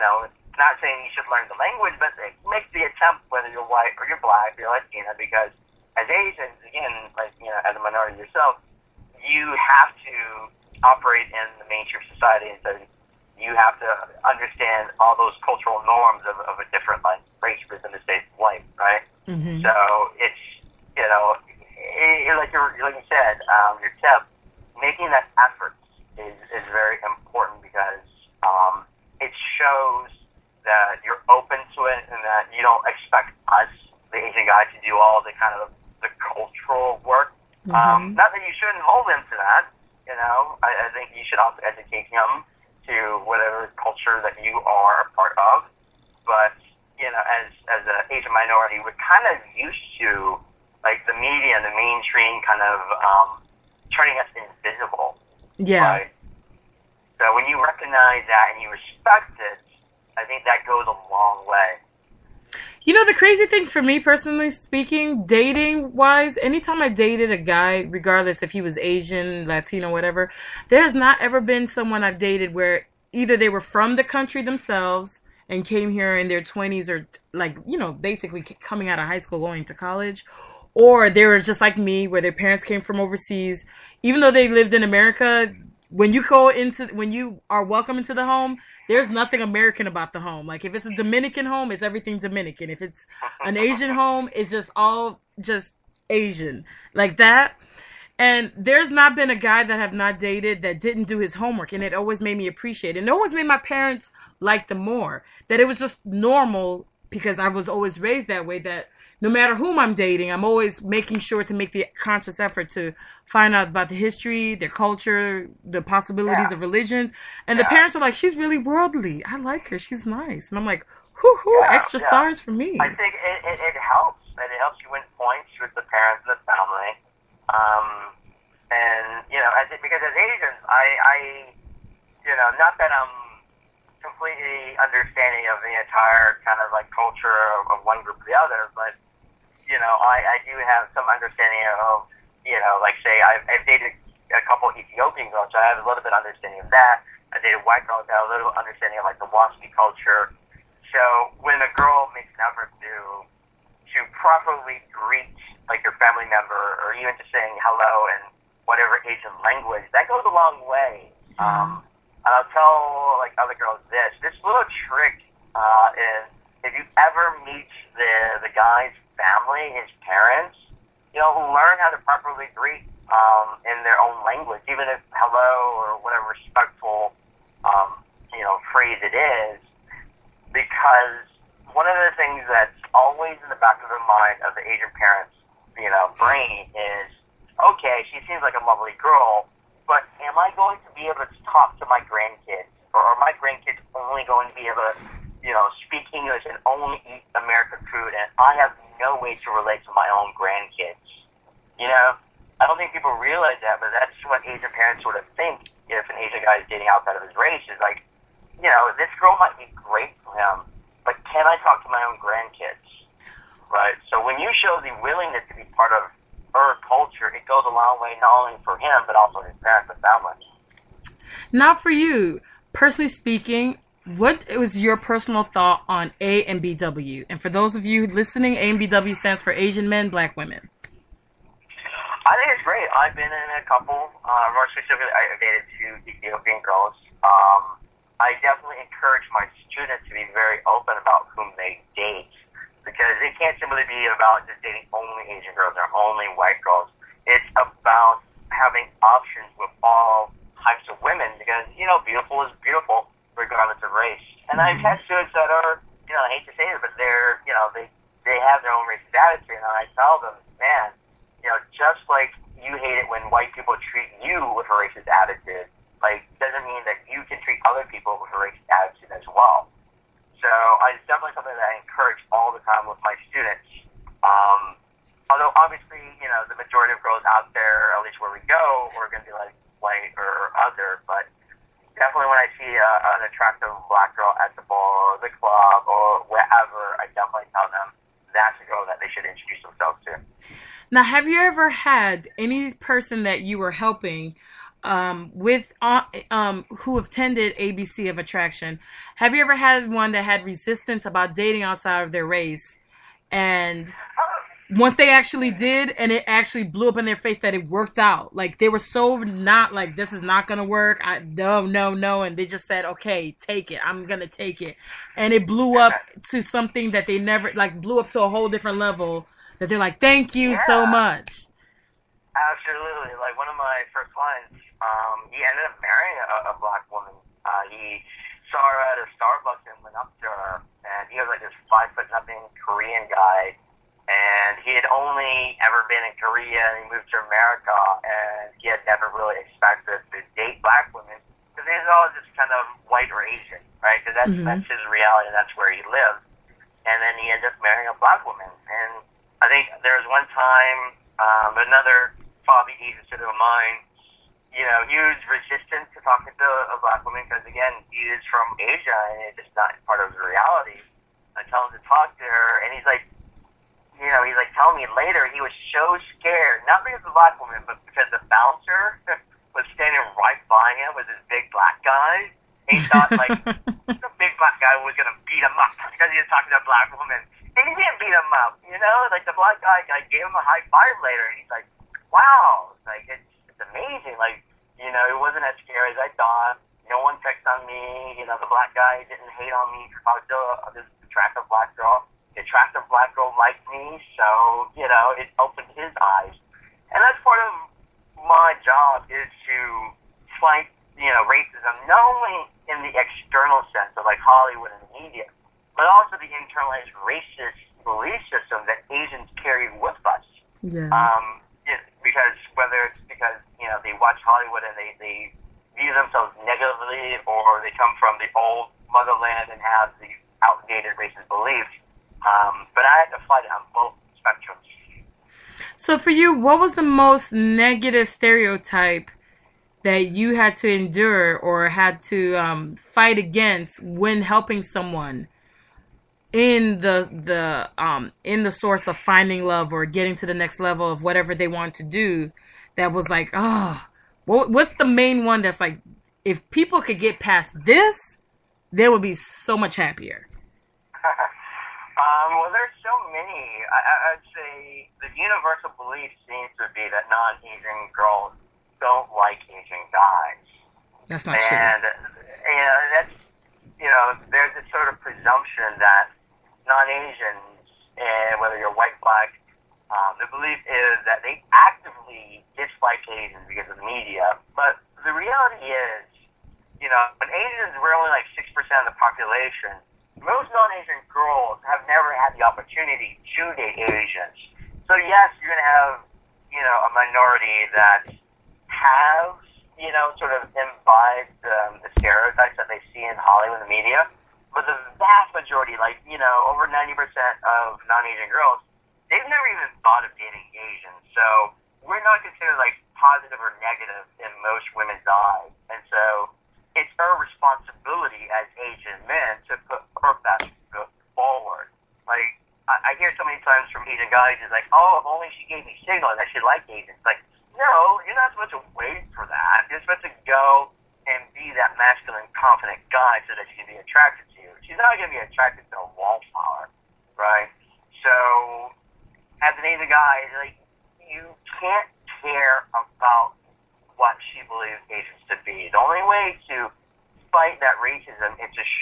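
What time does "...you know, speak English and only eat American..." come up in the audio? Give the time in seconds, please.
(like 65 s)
195 s.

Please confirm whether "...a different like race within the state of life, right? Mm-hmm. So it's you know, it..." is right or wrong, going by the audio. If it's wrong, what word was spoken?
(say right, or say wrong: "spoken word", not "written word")
right.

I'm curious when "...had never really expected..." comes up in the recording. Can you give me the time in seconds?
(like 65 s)
338 s.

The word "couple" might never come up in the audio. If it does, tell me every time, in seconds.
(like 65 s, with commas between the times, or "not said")
144 s, 233 s.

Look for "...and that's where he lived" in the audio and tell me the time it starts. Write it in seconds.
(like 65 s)
345 s.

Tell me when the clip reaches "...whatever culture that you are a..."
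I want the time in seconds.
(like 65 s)
43 s.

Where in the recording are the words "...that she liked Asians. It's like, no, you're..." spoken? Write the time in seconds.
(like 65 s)
516 s.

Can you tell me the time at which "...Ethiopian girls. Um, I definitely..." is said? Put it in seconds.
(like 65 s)
236 s.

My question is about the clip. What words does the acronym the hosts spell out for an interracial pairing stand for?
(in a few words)
Asian Men, Black Women.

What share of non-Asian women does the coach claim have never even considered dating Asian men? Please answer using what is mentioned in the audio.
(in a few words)
over 90%.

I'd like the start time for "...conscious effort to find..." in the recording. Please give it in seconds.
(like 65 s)
111 s.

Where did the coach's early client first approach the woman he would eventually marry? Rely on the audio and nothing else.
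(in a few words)
Starbucks.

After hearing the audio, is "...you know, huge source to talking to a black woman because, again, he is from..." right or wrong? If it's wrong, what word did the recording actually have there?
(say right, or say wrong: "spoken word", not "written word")
wrong: "resistance", not "source".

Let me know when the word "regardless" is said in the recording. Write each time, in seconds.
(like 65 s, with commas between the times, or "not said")
67 s, 253 s.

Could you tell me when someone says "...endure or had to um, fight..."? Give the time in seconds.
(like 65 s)
430 s.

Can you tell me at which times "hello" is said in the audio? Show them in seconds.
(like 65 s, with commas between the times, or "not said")
157 s, 175 s.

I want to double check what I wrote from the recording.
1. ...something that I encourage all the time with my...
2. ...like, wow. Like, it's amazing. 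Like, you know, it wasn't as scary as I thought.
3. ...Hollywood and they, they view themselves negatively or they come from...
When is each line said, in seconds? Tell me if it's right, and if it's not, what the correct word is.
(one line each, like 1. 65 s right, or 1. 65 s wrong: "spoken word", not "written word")
1. 271 s right
2. 381 s right
3. 414 s right.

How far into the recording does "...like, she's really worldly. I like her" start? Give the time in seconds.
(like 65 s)
117 s.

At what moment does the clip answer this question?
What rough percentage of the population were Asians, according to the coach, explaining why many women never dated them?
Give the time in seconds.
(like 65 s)
478 s.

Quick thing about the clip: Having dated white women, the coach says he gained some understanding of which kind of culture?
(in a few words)
Waspy culture.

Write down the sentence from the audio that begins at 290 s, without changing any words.
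Now, have you ever had any person that you were helping um, with uh, um, who attended ABC of Attraction.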